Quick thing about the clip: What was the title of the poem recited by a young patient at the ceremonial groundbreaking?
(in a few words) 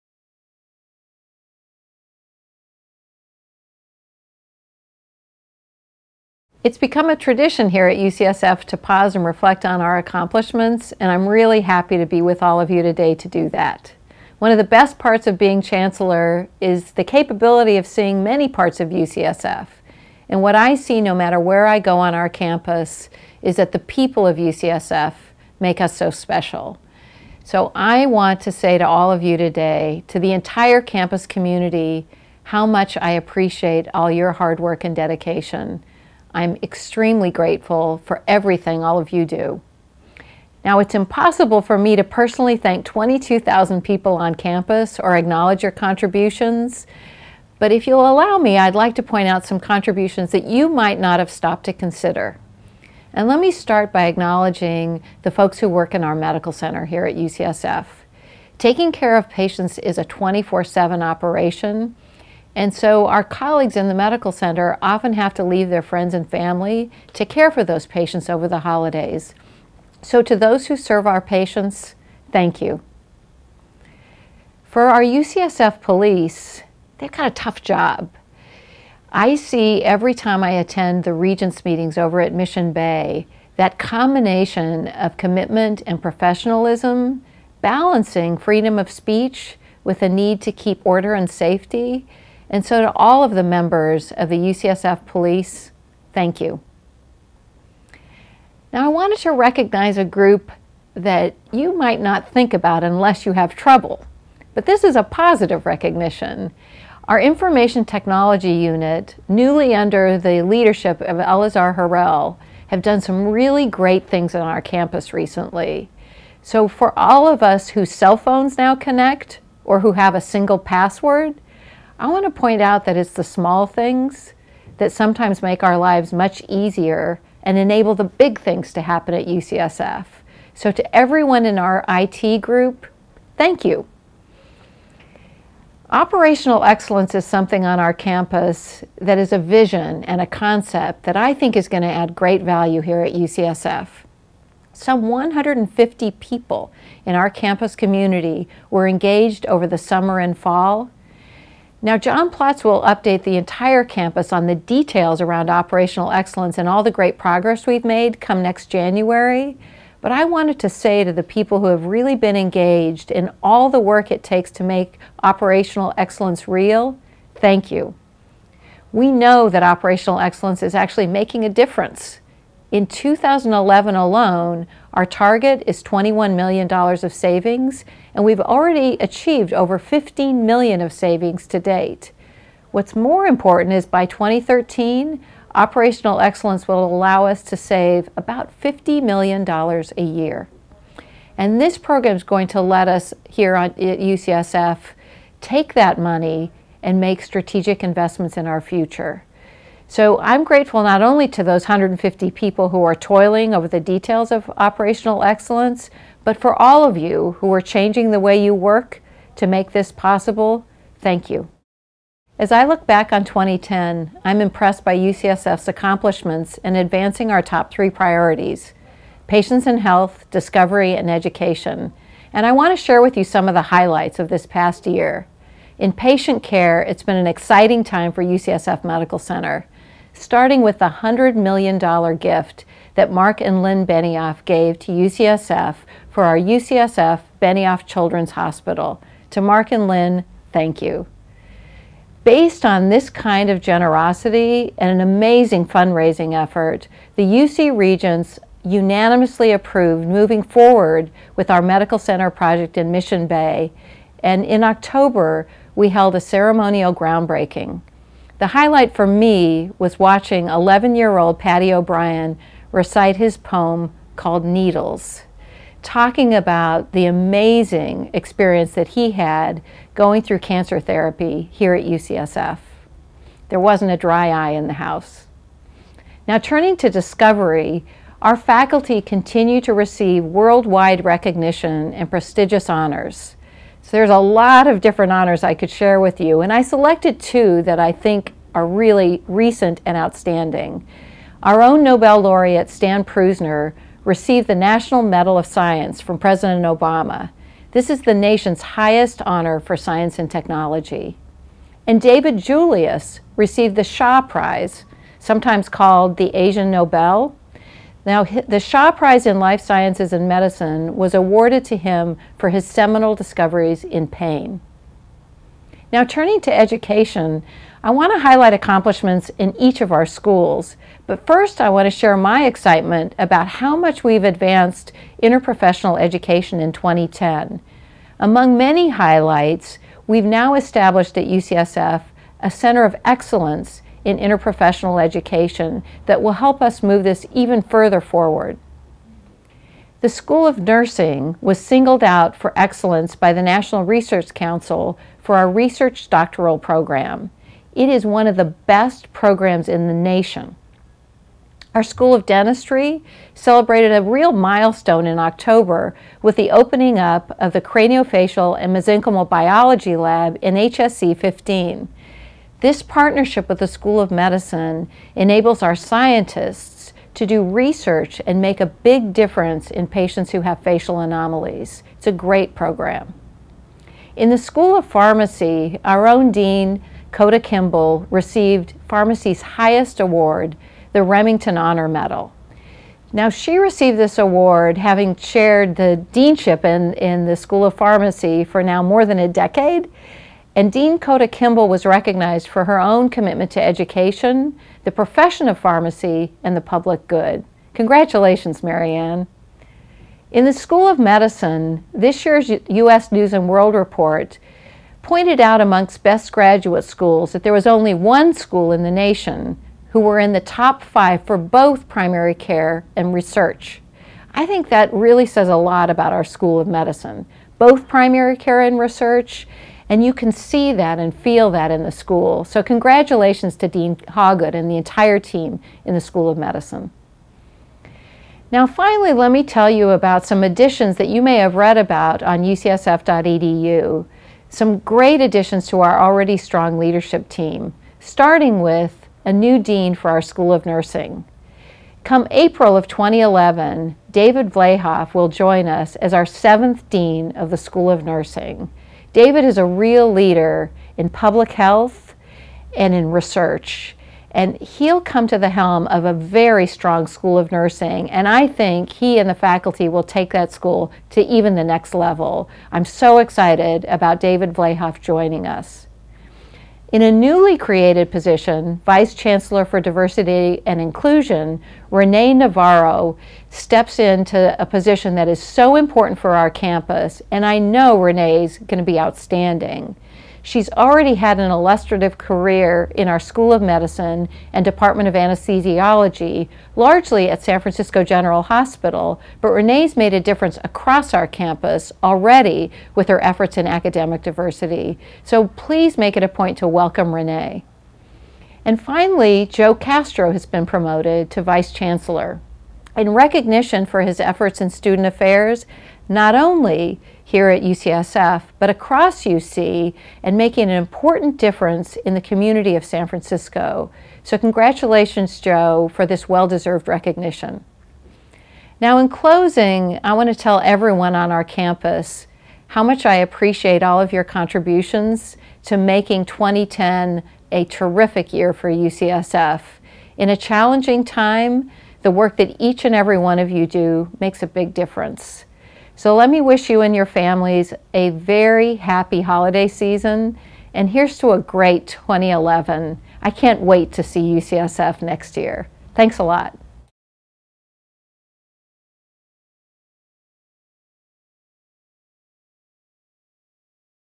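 Needles.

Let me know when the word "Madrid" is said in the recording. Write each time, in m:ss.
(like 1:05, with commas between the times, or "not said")
not said.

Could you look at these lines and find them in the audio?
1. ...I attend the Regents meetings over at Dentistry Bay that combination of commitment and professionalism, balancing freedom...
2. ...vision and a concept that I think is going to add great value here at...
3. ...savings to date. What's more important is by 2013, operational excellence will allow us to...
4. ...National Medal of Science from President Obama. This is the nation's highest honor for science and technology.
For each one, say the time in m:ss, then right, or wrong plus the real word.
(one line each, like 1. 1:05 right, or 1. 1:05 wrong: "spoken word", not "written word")
1. 1:20 wrong: "Mission", not "Dentistry"
2. 2:19 right
3. 3:00 right
4. 4:54 right.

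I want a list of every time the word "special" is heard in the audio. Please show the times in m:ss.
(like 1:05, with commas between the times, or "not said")
0:26.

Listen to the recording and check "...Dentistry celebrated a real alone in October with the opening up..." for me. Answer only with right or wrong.
wrong.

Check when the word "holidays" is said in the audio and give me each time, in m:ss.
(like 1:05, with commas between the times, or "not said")
1:08, 8:59.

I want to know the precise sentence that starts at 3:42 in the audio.
And I want to share with you some of the highlights of this past year.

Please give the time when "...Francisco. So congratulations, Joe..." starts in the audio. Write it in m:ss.
8:33.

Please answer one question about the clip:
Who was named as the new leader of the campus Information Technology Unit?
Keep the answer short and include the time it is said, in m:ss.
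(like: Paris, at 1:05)
Elazar Harel, at 1:51.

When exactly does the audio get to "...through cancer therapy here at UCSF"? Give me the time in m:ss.
4:30.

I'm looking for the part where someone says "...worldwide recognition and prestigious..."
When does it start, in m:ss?
4:40.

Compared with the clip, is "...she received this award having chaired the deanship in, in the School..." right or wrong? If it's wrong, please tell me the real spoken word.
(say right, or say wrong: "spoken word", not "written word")
right.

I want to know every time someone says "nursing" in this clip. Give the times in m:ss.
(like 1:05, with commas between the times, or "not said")
5:40, 7:20, 7:28, 7:37.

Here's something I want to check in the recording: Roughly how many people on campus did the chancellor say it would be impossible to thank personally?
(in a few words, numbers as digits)
22,000.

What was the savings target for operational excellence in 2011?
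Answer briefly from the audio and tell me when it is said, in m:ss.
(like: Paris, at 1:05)
$21 million, at 2:55.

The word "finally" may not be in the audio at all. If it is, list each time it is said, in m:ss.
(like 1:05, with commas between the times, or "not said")
7:08, 8:18.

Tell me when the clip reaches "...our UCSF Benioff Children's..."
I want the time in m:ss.
3:56.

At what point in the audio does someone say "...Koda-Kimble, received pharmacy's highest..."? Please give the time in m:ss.
6:17.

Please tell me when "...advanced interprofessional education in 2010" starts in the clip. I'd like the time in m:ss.
5:24.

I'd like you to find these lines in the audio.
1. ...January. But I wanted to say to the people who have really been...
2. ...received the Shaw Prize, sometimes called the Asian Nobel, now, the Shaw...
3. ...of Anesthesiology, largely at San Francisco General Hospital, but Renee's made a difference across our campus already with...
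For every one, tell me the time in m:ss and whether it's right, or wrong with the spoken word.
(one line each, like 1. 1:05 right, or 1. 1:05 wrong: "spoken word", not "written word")
1. 2:38 right
2. 5:03 right
3. 8:05 right.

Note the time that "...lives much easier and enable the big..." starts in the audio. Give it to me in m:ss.
2:05.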